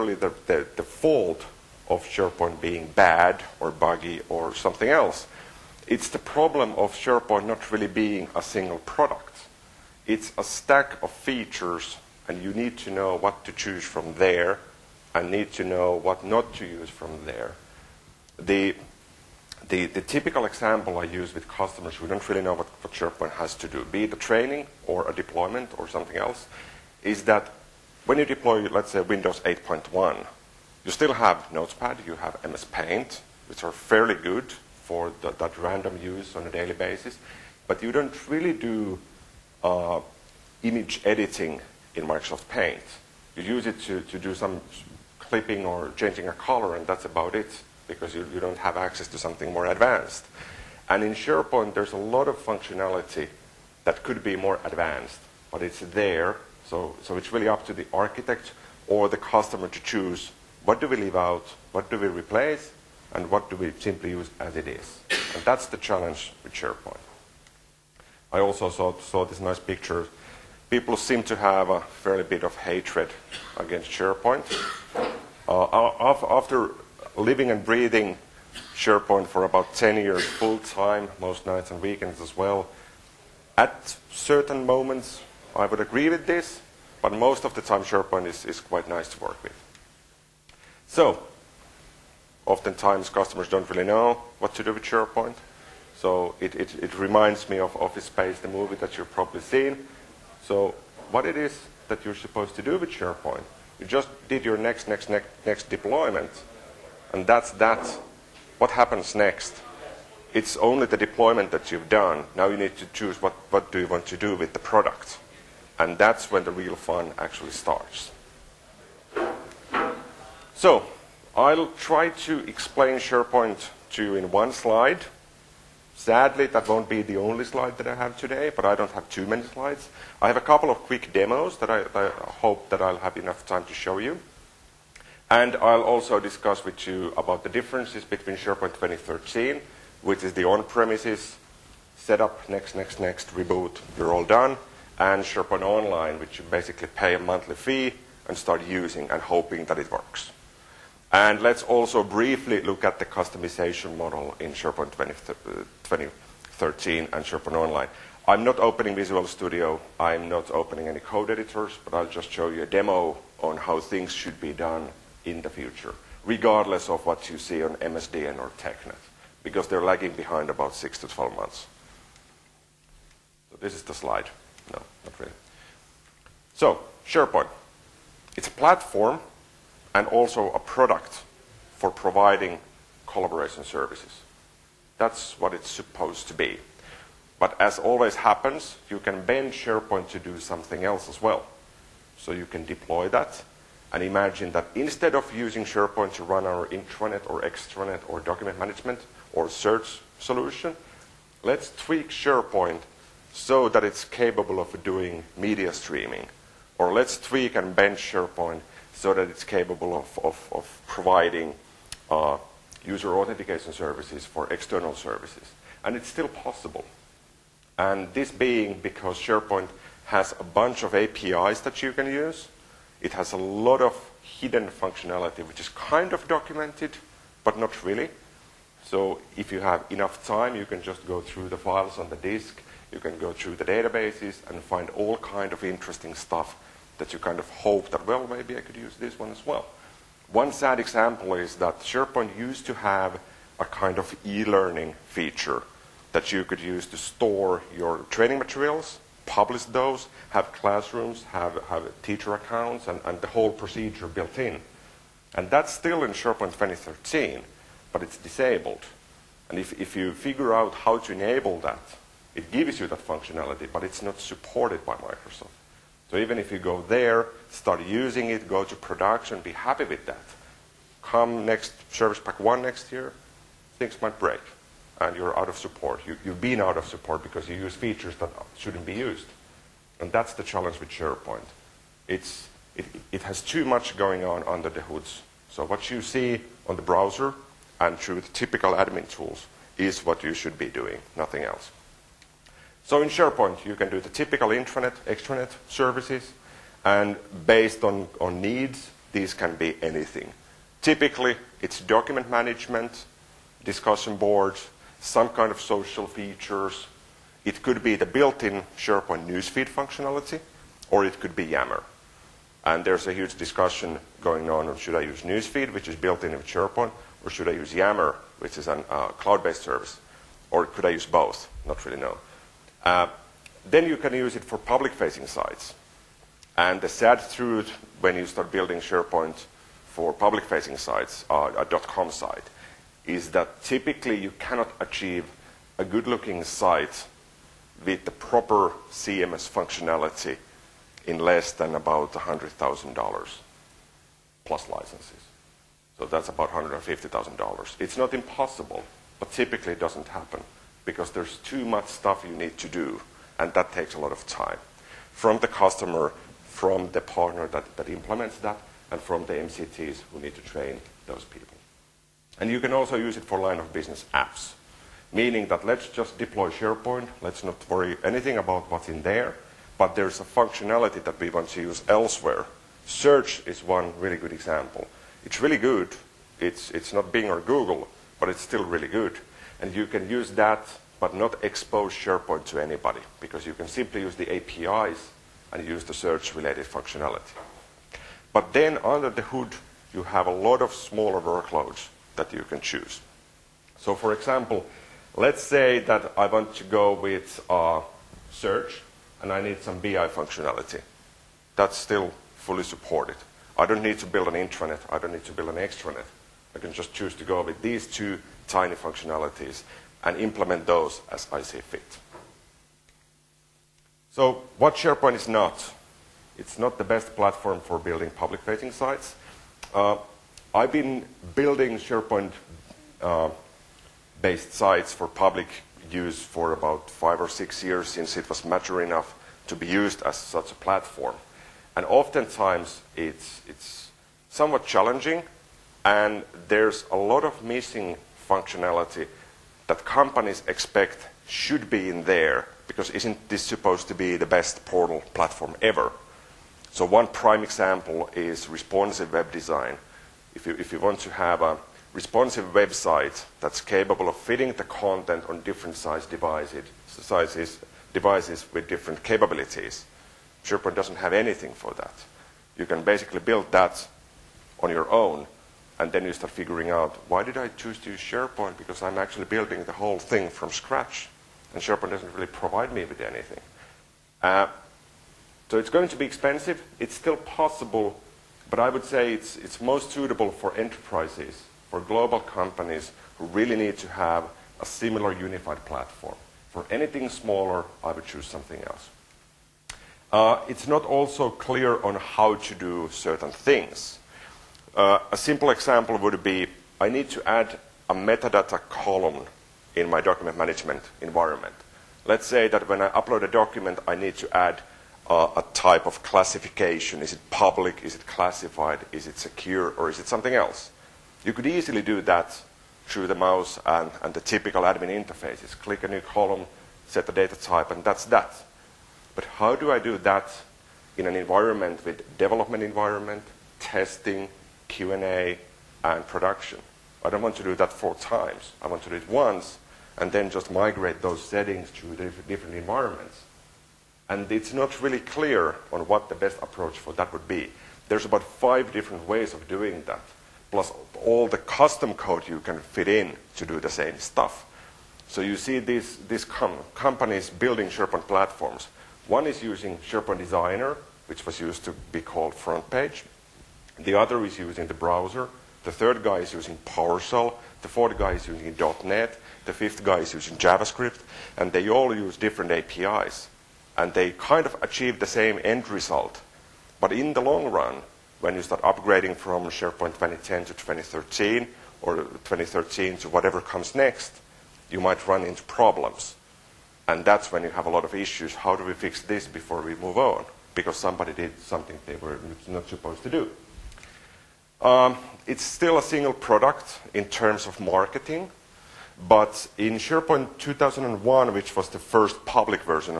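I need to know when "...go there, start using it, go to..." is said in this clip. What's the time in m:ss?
4:26.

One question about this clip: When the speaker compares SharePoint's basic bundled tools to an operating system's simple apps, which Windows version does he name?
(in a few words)
Windows 8.1.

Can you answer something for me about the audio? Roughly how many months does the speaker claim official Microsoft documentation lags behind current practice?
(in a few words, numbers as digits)
6 to 12 months.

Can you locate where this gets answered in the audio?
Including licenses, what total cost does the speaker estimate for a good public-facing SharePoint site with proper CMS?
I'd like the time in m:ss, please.
5:46.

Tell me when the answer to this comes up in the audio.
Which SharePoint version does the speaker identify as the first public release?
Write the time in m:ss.
9:49.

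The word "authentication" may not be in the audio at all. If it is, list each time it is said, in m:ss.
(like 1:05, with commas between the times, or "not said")
3:33.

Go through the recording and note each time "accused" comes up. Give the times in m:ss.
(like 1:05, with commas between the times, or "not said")
not said.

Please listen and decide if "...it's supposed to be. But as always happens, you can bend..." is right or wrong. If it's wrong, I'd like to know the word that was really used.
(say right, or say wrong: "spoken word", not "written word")
right.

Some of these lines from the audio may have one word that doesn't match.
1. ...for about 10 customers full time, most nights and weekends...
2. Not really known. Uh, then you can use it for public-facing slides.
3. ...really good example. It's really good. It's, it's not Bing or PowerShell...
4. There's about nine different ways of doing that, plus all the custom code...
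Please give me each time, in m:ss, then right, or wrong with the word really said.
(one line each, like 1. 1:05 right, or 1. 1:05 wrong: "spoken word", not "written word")
1. 1:19 wrong: "years", not "customers"
2. 5:21 wrong: "sites", not "slides"
3. 6:13 wrong: "Google", not "PowerShell"
4. 8:57 wrong: "five", not "nine".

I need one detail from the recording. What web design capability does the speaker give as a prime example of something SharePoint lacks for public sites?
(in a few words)
responsive web design.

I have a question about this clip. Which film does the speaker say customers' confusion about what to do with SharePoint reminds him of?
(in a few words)
Office Space.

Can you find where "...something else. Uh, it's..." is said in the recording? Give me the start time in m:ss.
8:08.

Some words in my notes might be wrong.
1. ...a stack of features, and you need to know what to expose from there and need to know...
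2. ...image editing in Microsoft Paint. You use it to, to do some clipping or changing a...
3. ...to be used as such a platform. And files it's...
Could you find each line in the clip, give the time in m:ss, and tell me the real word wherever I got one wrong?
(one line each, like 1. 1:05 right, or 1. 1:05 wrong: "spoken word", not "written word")
1. 0:10 wrong: "choose", not "expose"
2. 0:40 right
3. 7:09 wrong: "oftentimes", not "files".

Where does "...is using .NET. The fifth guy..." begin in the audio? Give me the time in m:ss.
9:18.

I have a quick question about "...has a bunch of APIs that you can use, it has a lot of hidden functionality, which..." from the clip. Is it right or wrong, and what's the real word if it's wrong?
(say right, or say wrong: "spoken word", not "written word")
right.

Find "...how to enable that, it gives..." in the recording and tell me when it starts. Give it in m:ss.
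4:20.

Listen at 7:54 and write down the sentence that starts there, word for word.
Uh, so it's going to be expensive.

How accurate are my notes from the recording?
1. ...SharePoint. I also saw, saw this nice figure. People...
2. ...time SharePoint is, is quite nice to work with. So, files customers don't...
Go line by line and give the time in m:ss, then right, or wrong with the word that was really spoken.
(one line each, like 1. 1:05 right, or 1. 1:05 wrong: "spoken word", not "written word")
1. 1:06 wrong: "picture", not "figure"
2. 1:27 wrong: "oftentimes", not "files".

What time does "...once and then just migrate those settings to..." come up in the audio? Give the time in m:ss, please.
8:49.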